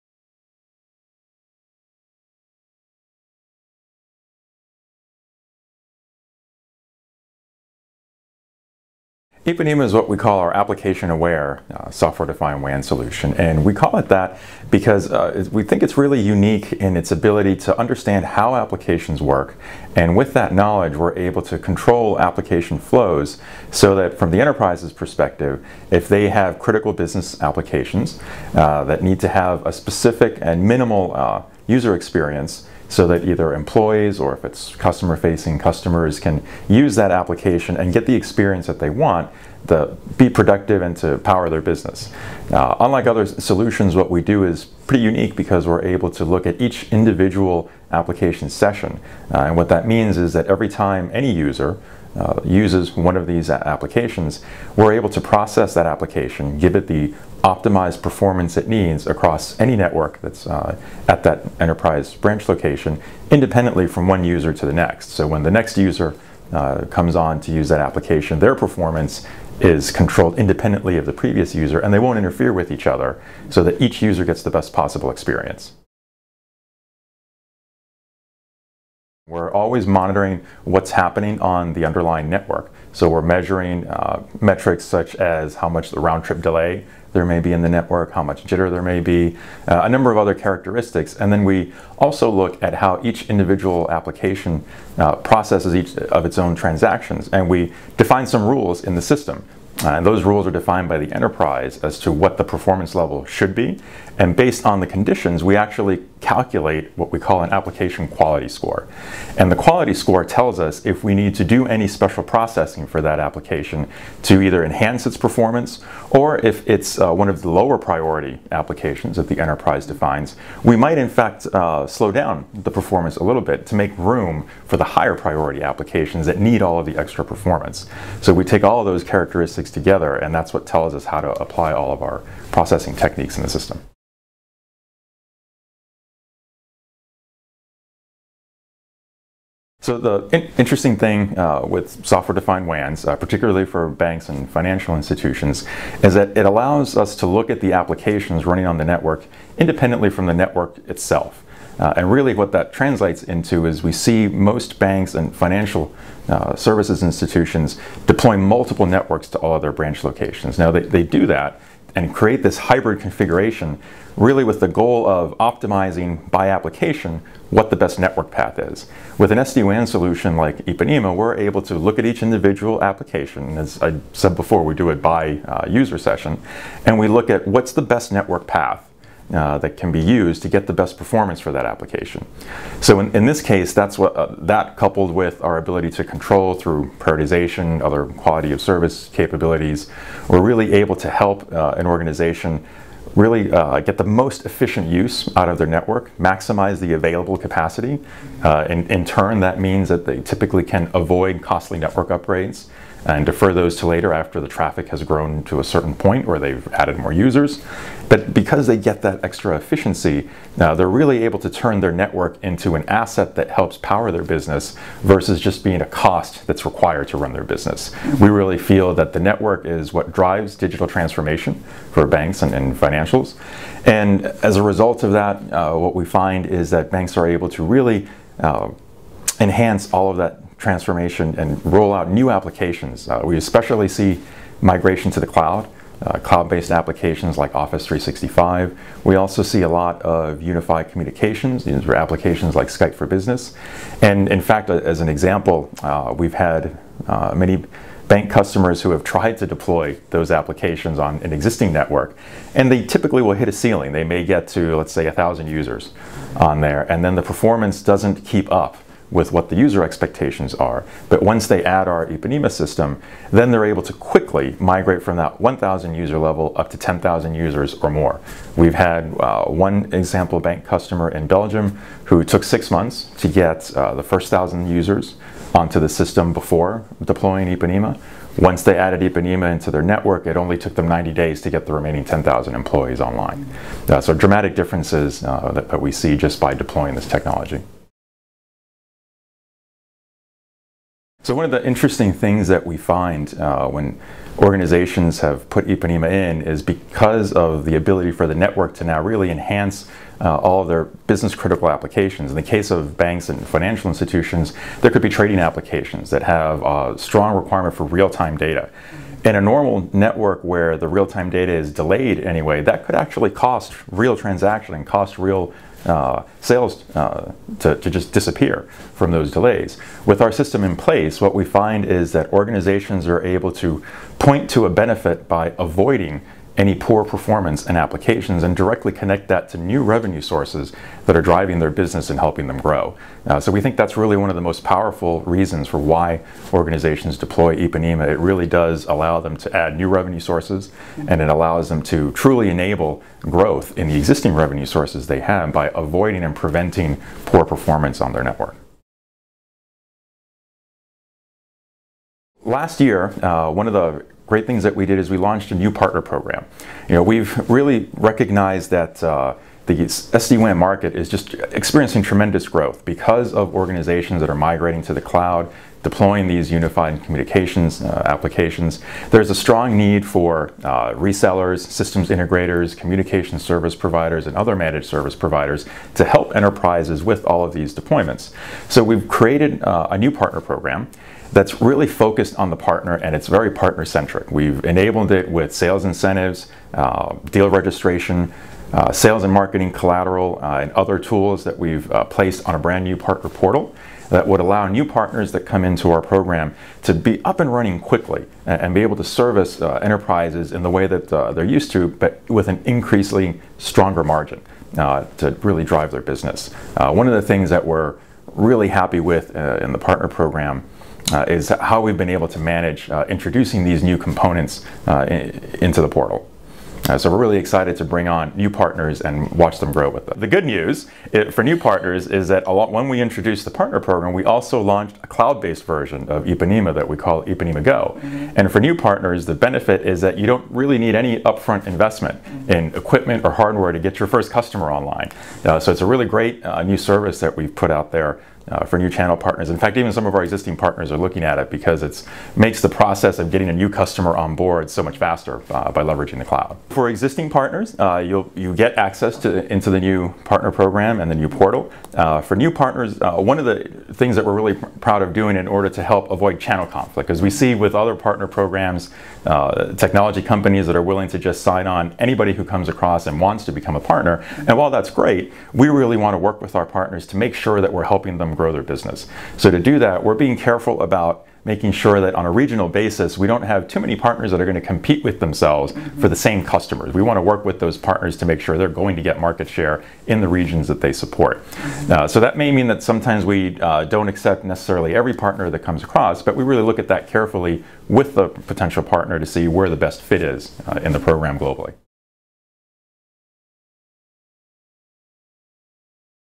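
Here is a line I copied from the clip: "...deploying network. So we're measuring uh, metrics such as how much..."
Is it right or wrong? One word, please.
wrong.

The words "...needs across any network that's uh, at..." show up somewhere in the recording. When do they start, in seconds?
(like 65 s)
58 s.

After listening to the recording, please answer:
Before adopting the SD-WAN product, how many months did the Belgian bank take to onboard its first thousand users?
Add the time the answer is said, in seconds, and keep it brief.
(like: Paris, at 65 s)
6, at 272 s.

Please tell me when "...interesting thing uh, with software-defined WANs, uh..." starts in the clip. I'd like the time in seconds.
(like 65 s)
140 s.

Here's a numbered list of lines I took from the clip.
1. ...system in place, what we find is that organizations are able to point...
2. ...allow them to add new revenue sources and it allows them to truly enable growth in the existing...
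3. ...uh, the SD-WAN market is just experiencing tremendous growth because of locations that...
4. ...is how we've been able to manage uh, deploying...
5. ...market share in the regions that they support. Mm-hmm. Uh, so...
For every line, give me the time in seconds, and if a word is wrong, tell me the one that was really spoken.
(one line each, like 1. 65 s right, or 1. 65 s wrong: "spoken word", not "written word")
1. 320 s right
2. 338 s right
3. 359 s wrong: "organizations", not "locations"
4. 411 s wrong: "introducing", not "deploying"
5. 479 s right.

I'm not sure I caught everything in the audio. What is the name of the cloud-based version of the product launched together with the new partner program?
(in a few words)
Ipanema Go.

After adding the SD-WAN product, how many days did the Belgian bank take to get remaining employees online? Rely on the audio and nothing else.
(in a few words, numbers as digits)
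90.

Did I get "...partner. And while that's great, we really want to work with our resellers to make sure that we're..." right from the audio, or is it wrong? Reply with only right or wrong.
wrong.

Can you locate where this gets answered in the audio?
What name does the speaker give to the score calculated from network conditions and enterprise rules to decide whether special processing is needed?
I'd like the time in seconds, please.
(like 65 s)
107 s.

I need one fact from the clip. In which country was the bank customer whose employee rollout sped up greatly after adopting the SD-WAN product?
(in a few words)
Belgium.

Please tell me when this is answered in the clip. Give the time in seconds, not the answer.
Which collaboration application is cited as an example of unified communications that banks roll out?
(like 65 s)
242 s.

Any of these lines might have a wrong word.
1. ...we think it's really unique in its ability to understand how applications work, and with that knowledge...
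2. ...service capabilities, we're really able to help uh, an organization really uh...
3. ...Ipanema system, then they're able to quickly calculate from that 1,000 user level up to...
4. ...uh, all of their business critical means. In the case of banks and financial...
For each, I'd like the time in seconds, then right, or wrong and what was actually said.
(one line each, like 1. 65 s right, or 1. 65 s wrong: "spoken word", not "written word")
1. 15 s right
2. 188 s right
3. 262 s wrong: "migrate", not "calculate"
4. 300 s wrong: "applications", not "means".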